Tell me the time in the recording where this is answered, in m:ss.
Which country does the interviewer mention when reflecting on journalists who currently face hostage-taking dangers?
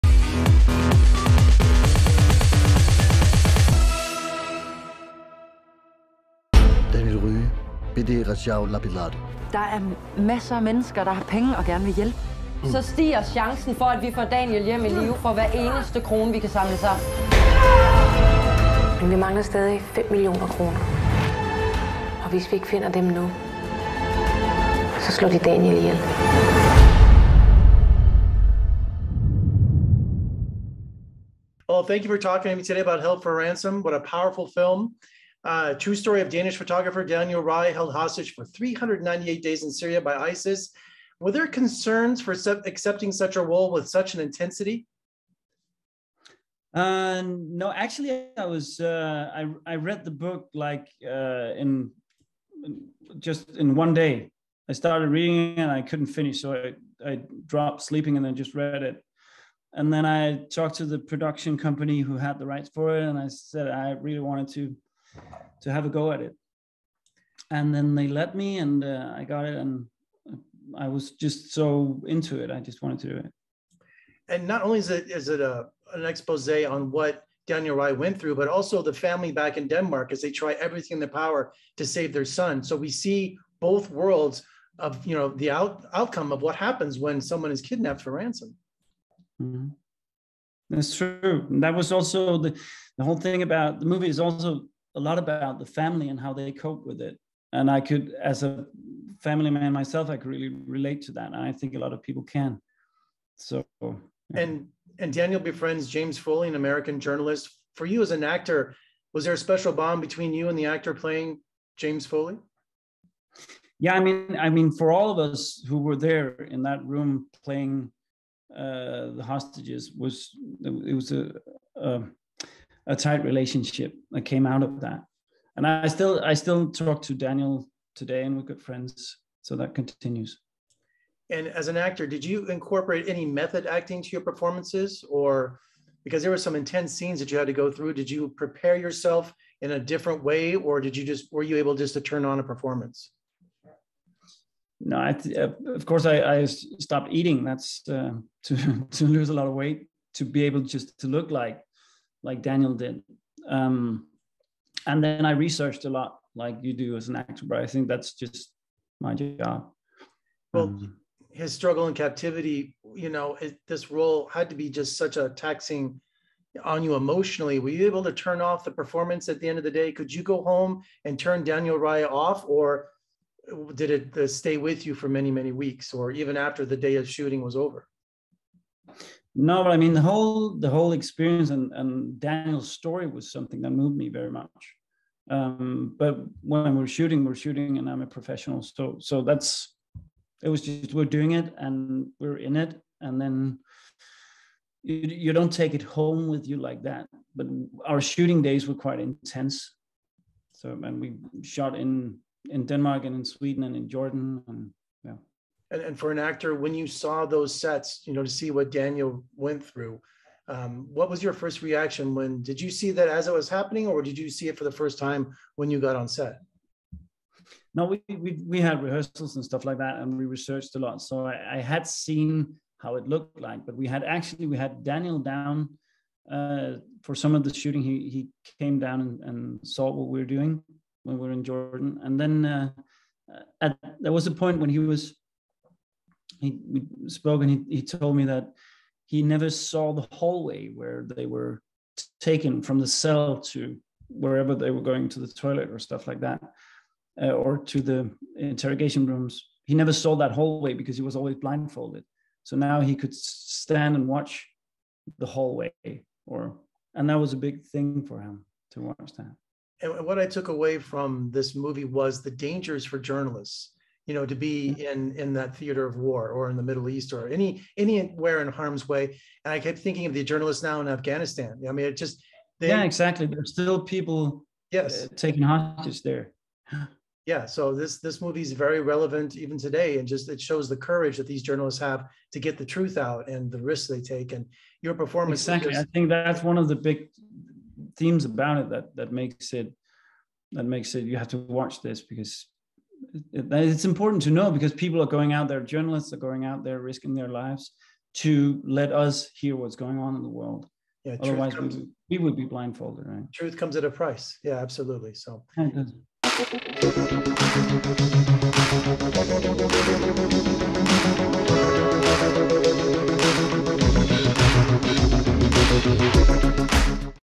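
4:30.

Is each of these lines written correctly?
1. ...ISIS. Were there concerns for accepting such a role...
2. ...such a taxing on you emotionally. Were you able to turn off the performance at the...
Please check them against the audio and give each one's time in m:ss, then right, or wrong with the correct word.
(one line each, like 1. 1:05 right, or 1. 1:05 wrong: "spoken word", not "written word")
1. 0:40 right
2. 2:44 right.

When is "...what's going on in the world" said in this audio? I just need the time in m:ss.
4:59.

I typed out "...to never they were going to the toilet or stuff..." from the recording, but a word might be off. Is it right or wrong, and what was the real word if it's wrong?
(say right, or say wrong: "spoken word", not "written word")
wrong: "wherever", not "never".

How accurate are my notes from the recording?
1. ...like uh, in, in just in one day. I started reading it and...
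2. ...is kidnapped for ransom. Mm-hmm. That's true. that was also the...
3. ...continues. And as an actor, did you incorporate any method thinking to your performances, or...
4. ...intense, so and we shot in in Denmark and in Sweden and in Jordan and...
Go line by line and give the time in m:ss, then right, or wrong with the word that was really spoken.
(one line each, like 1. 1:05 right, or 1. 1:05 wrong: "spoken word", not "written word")
1. 0:50 right
2. 1:27 right
3. 2:09 wrong: "acting", not "thinking"
4. 3:18 right.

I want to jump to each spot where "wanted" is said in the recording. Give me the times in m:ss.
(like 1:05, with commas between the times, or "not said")
1:04, 1:12.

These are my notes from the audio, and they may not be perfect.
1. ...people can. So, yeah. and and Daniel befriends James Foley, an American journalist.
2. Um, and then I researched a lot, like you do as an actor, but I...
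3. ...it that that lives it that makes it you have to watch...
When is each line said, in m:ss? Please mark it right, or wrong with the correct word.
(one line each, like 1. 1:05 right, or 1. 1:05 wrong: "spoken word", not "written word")
1. 1:42 right
2. 2:33 right
3. 4:48 wrong: "makes", not "lives".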